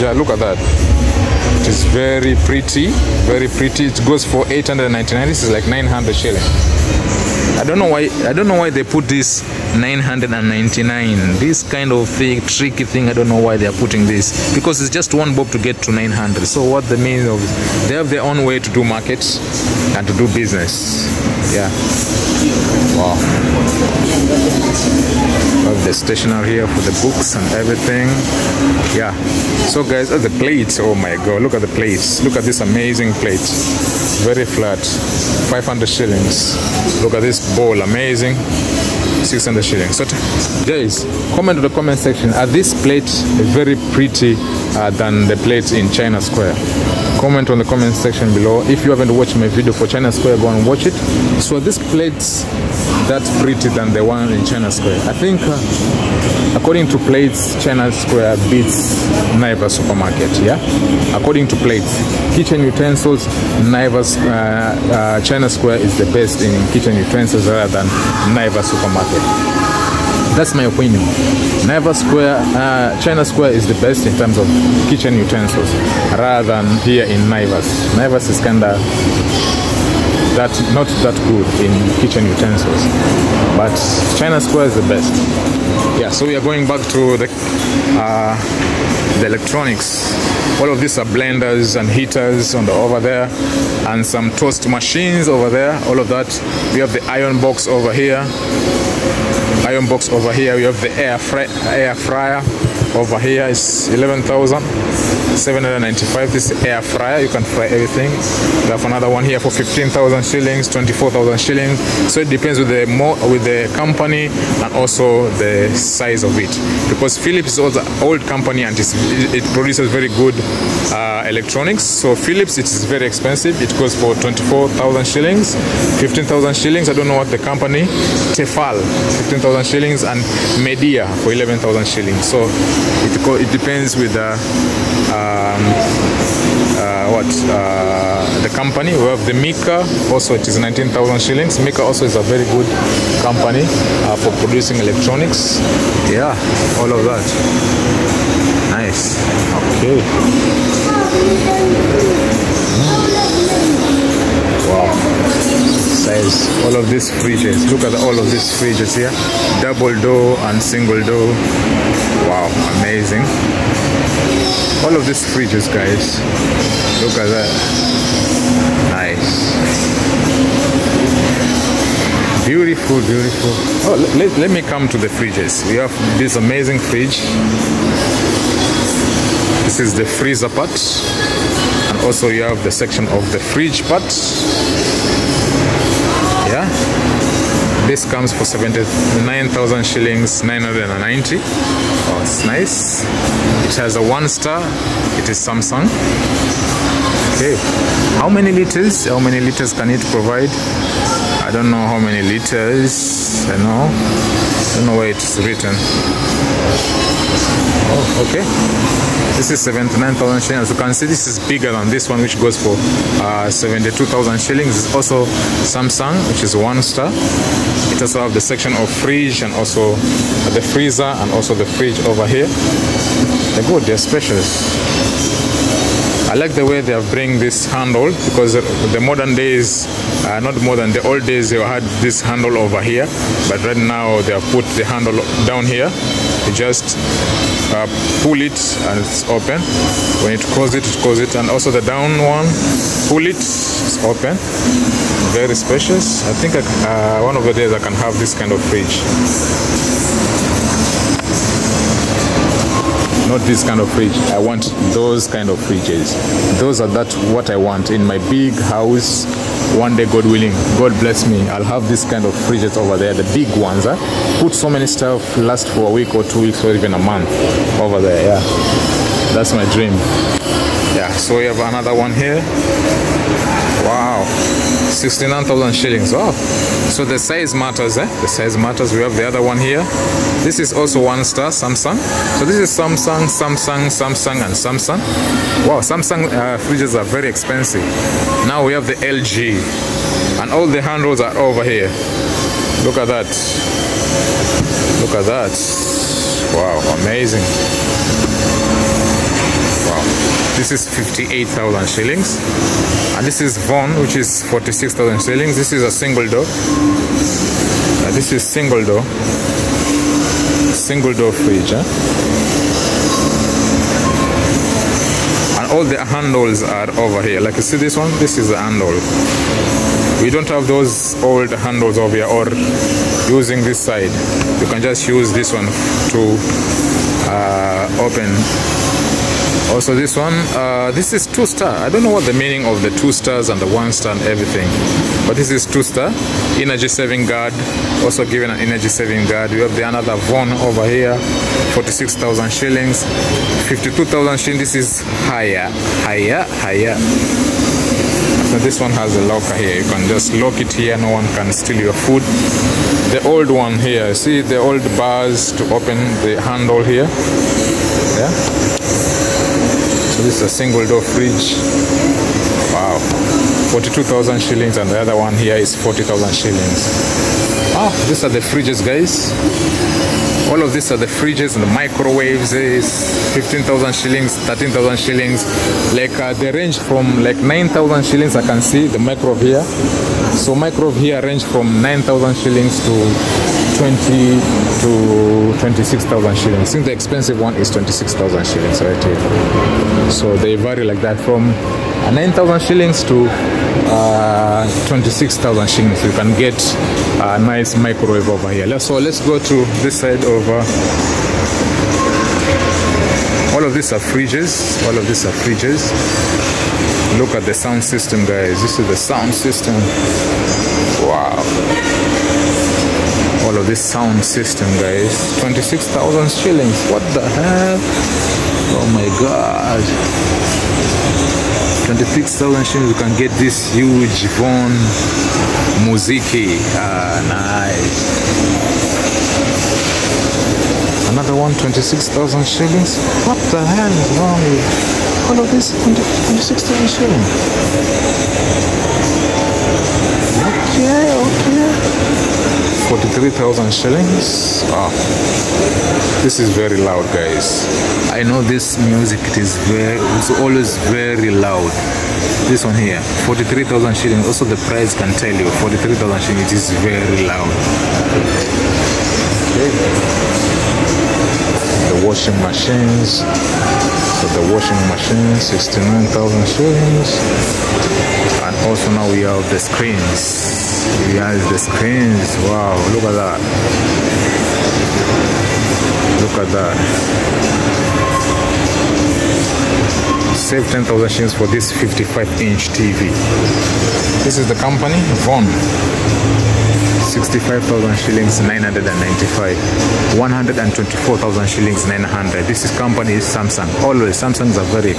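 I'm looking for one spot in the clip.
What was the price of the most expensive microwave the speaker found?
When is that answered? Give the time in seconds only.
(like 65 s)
386 s.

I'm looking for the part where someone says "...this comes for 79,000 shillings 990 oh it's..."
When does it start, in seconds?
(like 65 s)
187 s.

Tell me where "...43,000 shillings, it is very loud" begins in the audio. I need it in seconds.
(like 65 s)
455 s.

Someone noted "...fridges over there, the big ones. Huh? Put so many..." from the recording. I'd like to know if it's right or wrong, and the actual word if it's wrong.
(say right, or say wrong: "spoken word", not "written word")
right.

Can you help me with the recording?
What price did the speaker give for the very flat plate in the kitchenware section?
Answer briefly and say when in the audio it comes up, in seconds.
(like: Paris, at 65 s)
500 shillings, at 35 s.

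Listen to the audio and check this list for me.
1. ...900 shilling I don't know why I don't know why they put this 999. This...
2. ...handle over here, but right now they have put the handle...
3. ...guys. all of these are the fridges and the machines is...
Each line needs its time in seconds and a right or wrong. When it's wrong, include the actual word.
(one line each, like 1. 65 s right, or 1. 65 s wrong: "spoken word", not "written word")
1. 5 s right
2. 232 s right
3. 368 s wrong: "microwaves", not "machines".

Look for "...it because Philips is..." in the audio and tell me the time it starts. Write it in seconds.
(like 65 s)
116 s.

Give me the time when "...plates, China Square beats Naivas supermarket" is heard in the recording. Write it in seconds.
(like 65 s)
56 s.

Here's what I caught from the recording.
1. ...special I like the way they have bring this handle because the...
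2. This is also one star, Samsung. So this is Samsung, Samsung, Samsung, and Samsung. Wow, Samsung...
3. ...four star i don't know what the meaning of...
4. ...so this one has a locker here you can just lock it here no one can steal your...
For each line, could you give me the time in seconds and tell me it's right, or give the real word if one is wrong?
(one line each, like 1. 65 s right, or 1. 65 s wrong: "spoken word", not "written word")
1. 223 s right
2. 280 s right
3. 331 s wrong: "two", not "four"
4. 348 s right.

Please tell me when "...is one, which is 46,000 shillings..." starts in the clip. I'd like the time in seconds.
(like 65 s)
303 s.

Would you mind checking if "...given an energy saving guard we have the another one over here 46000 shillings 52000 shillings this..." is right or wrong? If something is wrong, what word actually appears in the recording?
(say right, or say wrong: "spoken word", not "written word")
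right.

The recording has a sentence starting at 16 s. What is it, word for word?
So what the mean of they have their own way to do market and to do business.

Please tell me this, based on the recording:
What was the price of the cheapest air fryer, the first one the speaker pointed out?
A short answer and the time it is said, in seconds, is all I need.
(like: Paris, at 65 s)
11,795 shillings, at 103 s.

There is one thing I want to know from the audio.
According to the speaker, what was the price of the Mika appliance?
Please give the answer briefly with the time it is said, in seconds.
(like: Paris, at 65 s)
19,000 shillings, at 140 s.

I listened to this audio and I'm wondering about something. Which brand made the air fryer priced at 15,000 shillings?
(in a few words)
Tefal.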